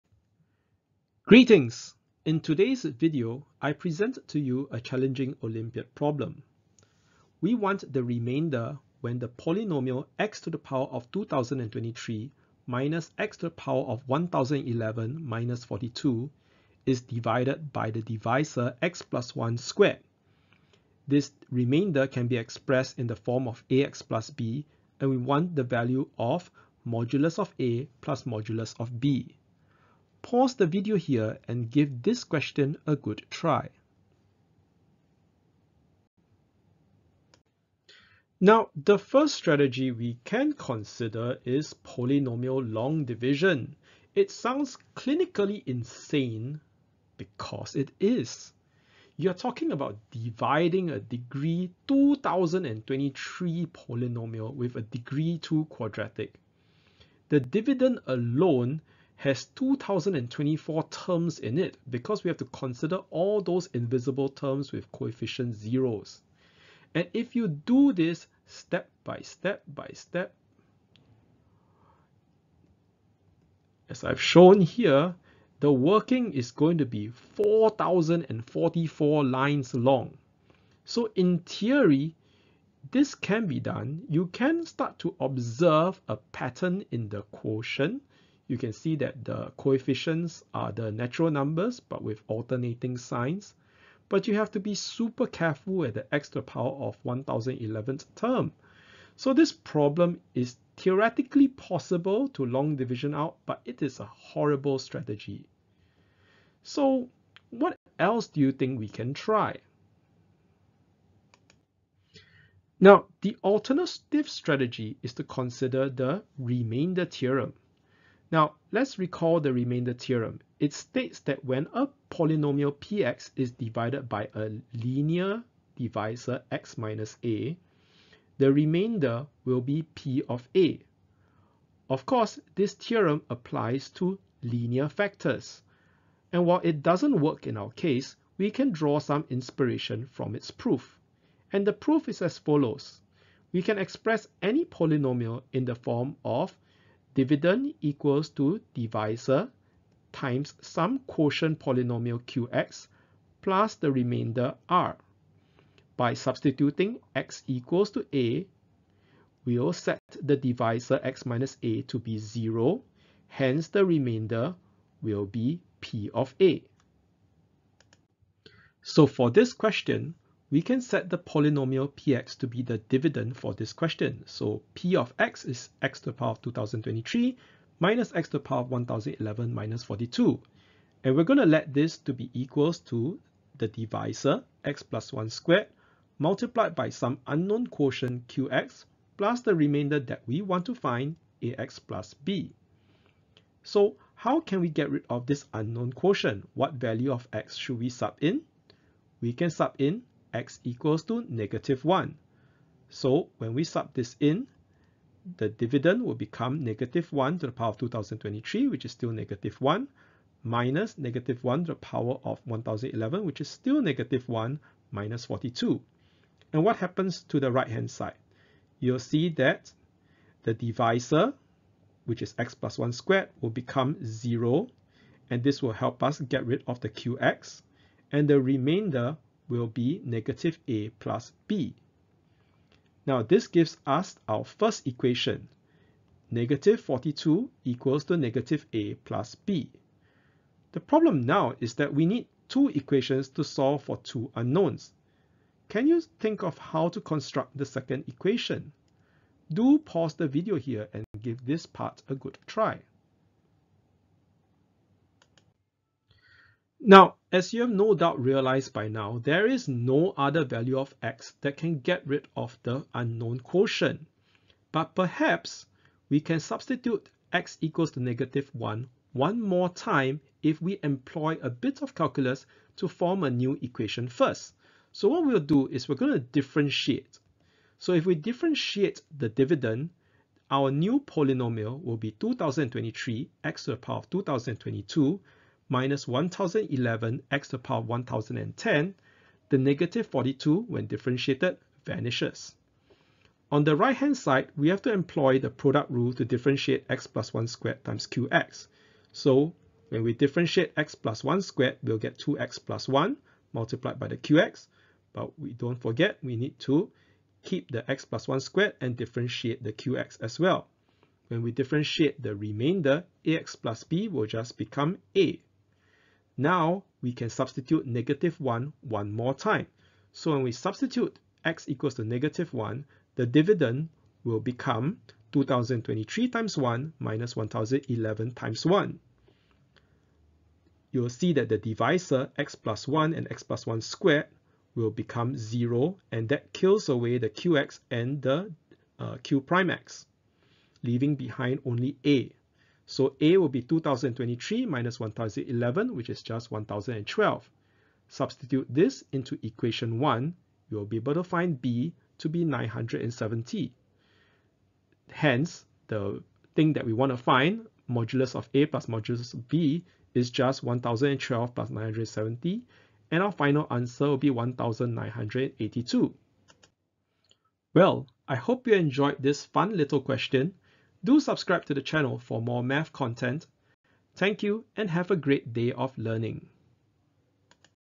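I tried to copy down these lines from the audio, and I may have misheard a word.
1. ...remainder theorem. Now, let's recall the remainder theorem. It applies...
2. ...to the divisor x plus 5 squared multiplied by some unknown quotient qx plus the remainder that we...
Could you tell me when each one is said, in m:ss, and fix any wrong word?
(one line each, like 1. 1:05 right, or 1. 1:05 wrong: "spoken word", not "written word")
1. 1:56 wrong: "states", not "applies"
2. 3:02 wrong: "1", not "5".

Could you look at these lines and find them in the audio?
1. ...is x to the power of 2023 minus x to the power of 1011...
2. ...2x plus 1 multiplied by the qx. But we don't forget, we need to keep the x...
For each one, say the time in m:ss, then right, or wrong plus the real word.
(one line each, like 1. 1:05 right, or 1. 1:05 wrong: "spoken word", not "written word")
1. 2:55 right
2. 5:02 right.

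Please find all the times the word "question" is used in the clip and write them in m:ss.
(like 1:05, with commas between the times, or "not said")
0:32, 2:49, 2:53, 6:10.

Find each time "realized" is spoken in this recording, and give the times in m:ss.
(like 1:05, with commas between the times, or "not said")
4:18.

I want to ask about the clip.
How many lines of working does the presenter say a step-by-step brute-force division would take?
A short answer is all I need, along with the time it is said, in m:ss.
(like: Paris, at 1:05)
4,044, at 1:17.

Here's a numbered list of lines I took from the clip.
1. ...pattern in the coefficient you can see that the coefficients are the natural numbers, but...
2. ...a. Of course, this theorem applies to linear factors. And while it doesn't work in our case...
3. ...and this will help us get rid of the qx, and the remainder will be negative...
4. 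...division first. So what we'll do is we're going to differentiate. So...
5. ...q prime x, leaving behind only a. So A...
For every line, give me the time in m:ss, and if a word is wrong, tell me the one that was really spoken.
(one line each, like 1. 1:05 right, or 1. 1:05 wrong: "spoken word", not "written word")
1. 1:26 wrong: "quotient", not "coefficient"
2. 2:10 right
3. 3:45 right
4. 4:33 wrong: "equation", not "division"
5. 5:39 right.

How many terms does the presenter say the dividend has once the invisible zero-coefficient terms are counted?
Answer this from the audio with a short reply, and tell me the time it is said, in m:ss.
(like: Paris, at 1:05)
2024, at 0:59.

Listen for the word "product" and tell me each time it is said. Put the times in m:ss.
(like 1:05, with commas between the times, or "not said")
4:55.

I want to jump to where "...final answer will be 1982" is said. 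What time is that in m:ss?
6:03.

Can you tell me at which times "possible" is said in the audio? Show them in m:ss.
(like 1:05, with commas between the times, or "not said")
1:41.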